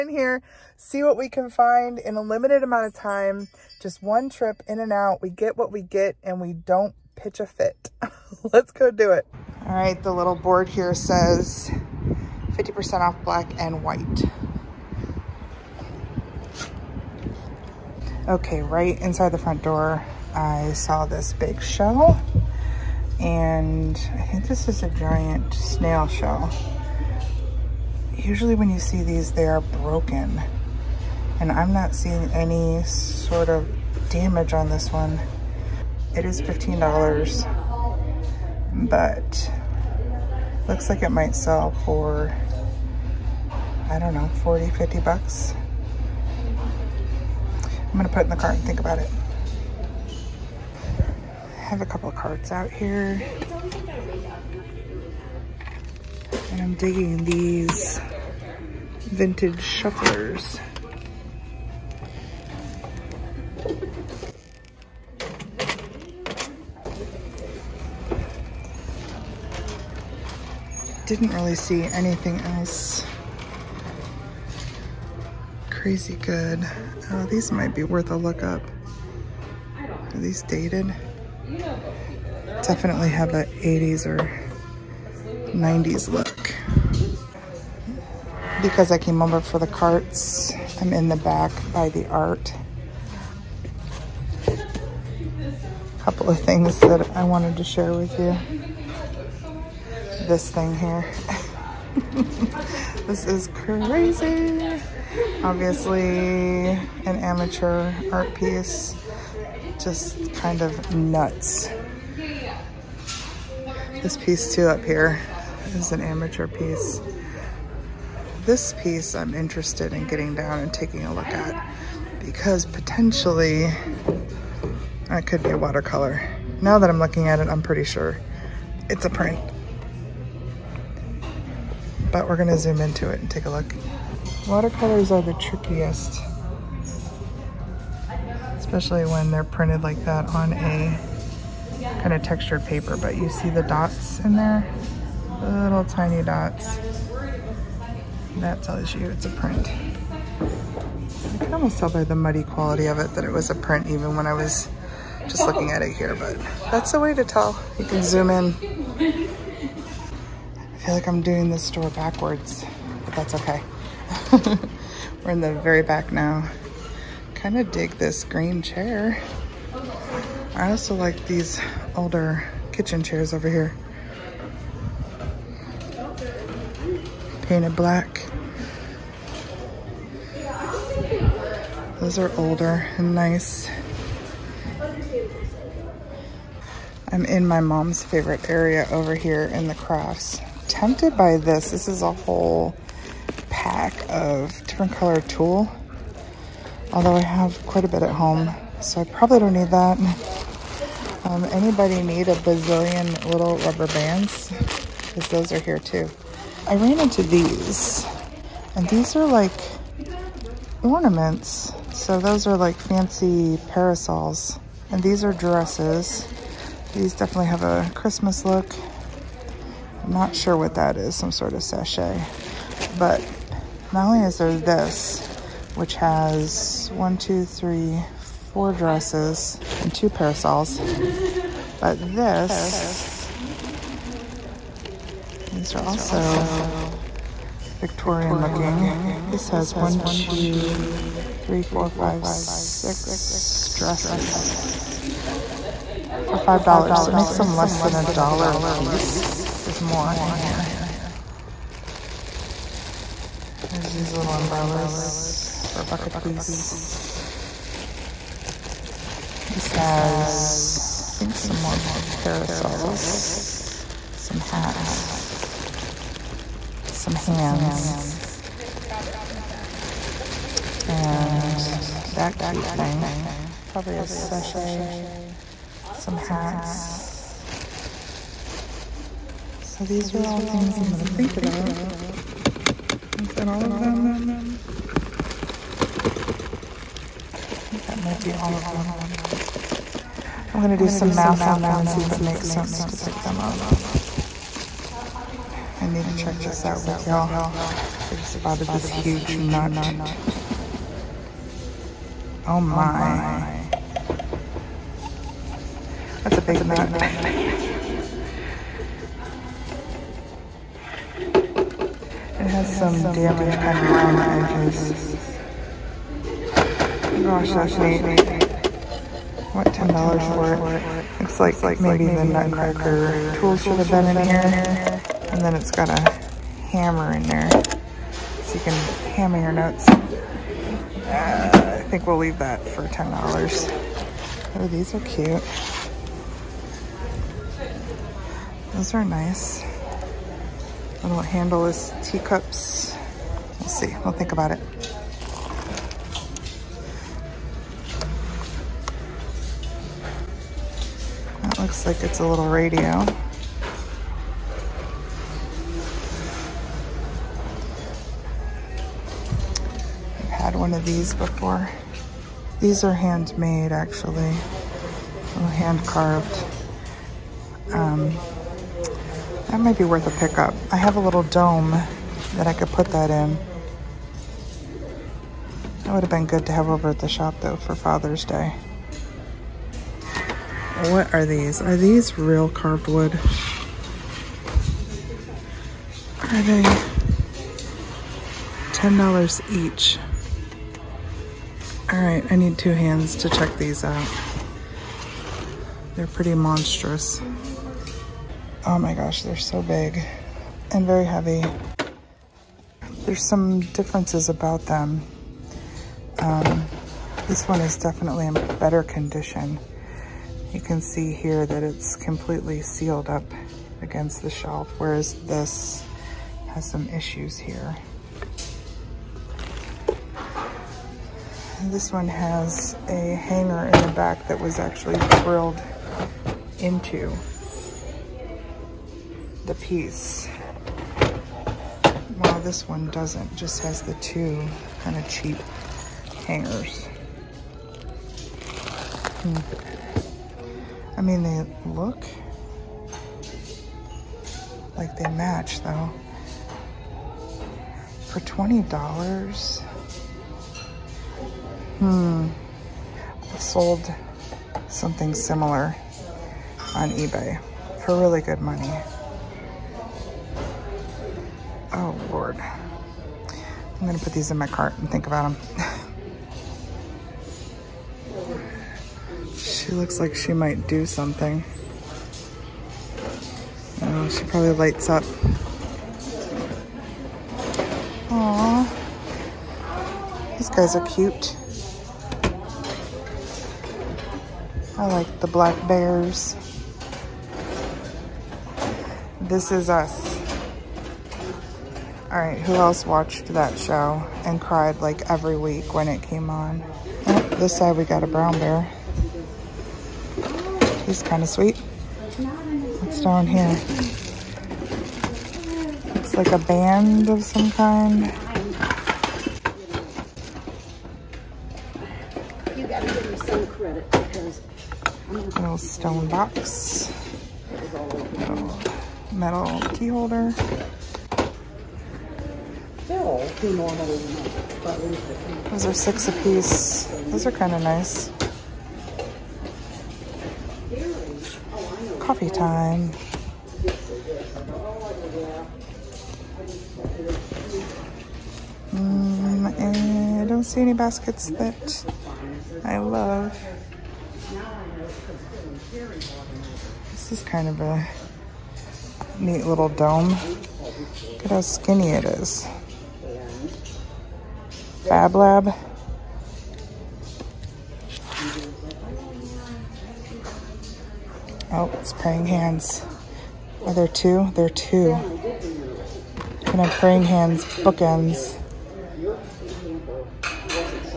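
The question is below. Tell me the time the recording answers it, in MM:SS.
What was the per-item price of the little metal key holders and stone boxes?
08:45.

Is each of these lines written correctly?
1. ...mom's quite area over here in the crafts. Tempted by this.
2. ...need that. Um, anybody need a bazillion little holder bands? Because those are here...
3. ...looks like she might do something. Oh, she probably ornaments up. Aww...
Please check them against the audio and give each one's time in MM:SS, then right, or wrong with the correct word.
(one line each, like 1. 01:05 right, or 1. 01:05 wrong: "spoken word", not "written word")
1. 03:07 wrong: "favorite", not "quite"
2. 03:19 wrong: "rubber", not "holder"
3. 07:49 wrong: "lights", not "ornaments".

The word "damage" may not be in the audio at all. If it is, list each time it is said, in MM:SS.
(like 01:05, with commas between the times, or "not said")
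00:34, 05:13.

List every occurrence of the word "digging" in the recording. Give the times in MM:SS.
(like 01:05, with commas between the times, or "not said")
00:56.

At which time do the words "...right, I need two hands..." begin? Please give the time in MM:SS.
06:32.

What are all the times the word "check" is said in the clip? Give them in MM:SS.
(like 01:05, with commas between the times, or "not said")
04:56, 06:33.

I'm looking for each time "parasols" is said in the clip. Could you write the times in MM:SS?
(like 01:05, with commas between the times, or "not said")
03:33, 03:50, 04:22.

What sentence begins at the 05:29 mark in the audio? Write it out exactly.
Uh, I think we'll leave that for $10.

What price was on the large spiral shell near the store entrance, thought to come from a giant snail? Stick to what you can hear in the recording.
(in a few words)
$15.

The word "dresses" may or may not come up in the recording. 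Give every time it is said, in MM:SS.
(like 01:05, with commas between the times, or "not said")
03:35, 03:48, 04:03.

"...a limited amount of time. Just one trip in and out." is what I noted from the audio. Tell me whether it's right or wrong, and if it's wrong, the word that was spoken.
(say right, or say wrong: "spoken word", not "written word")
right.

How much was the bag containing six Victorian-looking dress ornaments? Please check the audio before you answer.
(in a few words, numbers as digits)
$5.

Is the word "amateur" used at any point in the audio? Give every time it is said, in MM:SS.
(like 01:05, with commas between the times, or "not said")
01:47, 01:56.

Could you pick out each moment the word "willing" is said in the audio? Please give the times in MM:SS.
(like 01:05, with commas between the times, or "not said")
not said.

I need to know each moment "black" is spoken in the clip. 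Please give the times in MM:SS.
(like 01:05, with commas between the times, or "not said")
00:13, 02:57, 08:05.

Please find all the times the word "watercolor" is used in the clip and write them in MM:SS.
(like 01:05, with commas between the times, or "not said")
02:05, 02:14.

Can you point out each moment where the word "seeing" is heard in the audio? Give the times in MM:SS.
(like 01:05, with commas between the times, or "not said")
00:31.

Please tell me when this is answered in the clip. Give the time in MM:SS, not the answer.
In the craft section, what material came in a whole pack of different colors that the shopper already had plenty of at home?
03:15.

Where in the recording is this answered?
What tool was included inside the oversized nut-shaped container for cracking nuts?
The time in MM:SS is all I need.
05:25.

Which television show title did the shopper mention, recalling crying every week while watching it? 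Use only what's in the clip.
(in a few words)
This Is Us.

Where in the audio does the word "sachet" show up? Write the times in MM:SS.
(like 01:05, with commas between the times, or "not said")
03:41, 04:34.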